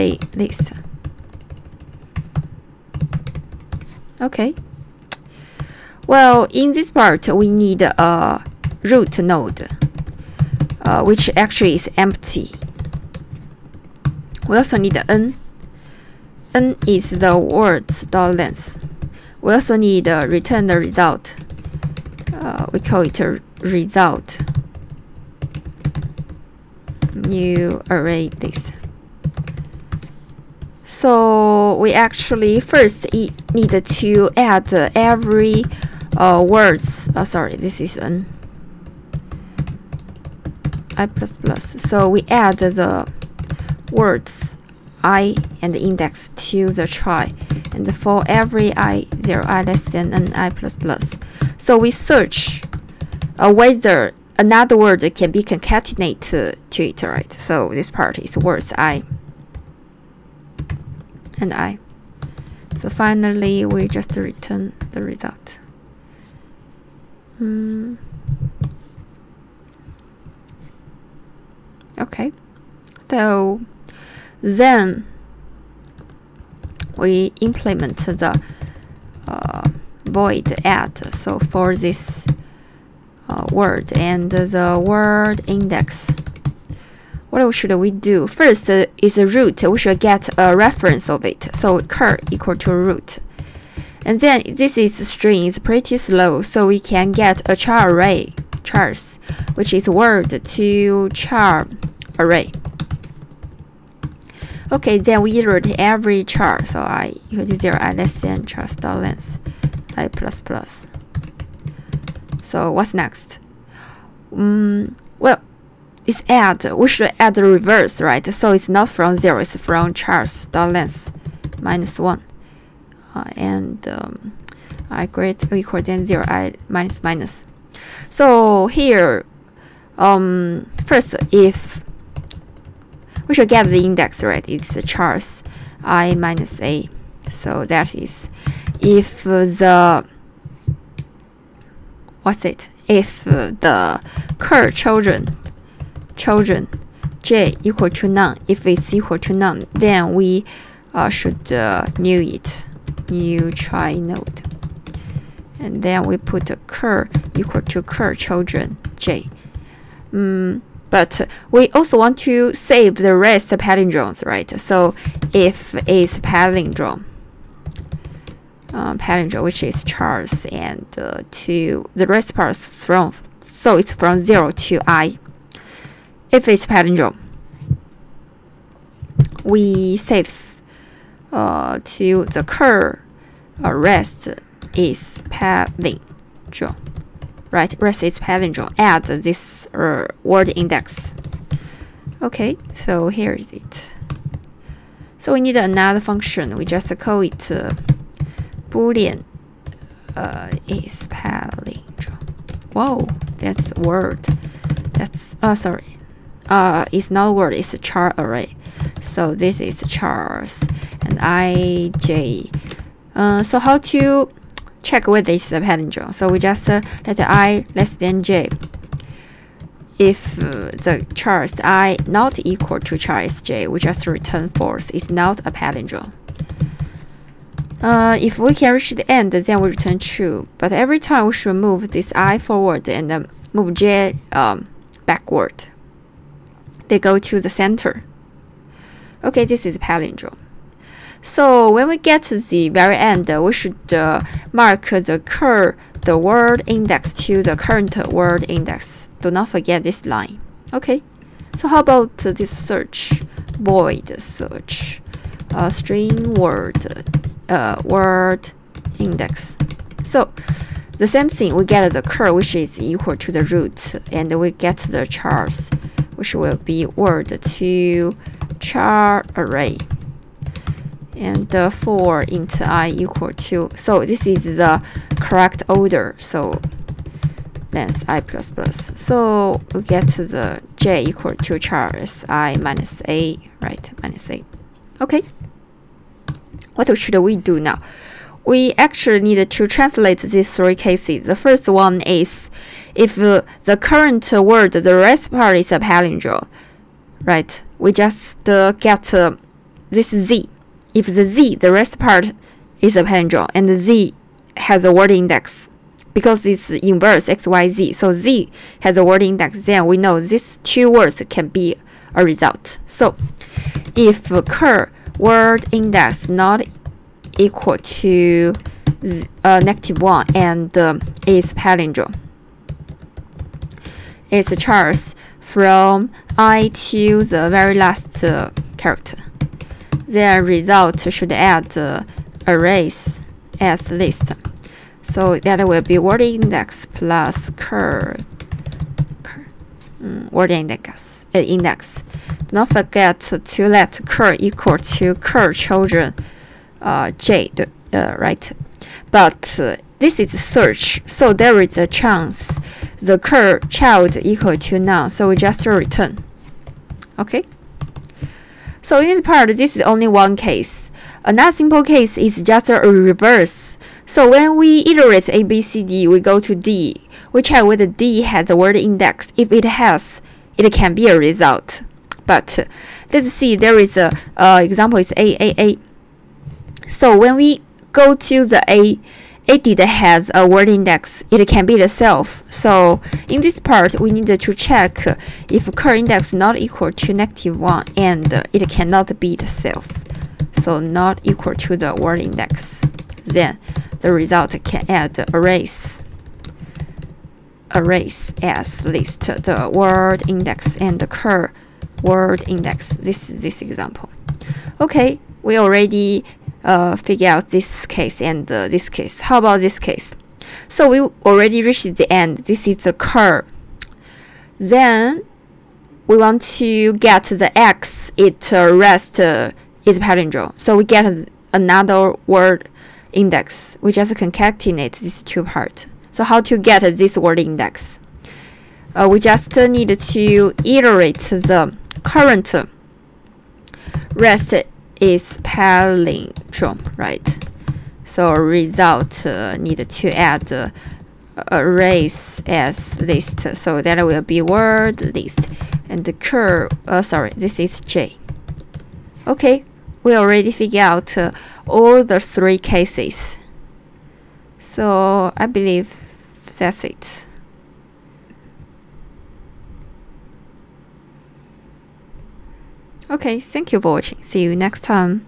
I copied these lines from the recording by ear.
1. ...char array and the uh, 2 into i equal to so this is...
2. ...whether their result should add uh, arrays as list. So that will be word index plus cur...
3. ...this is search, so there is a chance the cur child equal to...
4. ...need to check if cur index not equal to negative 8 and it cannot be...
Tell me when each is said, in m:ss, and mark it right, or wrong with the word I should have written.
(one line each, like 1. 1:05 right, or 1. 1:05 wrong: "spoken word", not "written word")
1. 4:28 wrong: "4", not "2"
2. 5:28 wrong: "character", not "whether"
3. 5:49 right
4. 6:24 wrong: "1", not "8".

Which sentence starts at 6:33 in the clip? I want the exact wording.
Then the result can add arrays, arrays as list the word index and the cur word index.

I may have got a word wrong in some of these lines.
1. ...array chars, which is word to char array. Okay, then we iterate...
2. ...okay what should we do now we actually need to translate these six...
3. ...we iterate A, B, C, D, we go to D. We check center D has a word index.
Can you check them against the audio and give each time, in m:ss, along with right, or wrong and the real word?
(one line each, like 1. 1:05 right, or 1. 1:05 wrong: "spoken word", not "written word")
1. 1:37 right
2. 4:45 wrong: "three", not "six"
3. 6:04 wrong: "whether", not "center".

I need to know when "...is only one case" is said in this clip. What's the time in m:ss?
5:59.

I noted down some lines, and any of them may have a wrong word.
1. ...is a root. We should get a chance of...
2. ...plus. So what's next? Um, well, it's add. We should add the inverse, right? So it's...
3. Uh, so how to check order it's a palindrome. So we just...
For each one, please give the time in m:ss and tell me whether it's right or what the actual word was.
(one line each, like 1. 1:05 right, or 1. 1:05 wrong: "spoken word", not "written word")
1. 1:29 wrong: "reference", not "chance"
2. 1:50 wrong: "reverse", not "inverse"
3. 3:33 wrong: "whether", not "order".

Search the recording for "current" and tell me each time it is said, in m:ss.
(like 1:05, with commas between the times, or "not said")
4:07, 4:53, 7:12.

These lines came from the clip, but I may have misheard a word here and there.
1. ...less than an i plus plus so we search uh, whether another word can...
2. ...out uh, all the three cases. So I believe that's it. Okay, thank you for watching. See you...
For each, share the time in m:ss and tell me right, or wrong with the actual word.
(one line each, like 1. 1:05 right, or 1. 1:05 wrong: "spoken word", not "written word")
1. 0:49 right
2. 7:30 right.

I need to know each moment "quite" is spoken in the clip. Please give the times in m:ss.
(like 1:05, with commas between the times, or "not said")
not said.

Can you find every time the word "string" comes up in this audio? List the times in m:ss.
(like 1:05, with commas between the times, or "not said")
1:35, 4:15.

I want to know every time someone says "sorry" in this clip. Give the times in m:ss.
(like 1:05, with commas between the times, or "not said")
0:37, 3:25, 7:27.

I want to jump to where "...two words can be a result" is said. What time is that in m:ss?
5:10.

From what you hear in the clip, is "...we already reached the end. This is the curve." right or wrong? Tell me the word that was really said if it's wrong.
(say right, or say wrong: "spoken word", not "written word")
right.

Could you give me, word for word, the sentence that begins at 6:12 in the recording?
But let's see, there is a uh, example is A, A, A.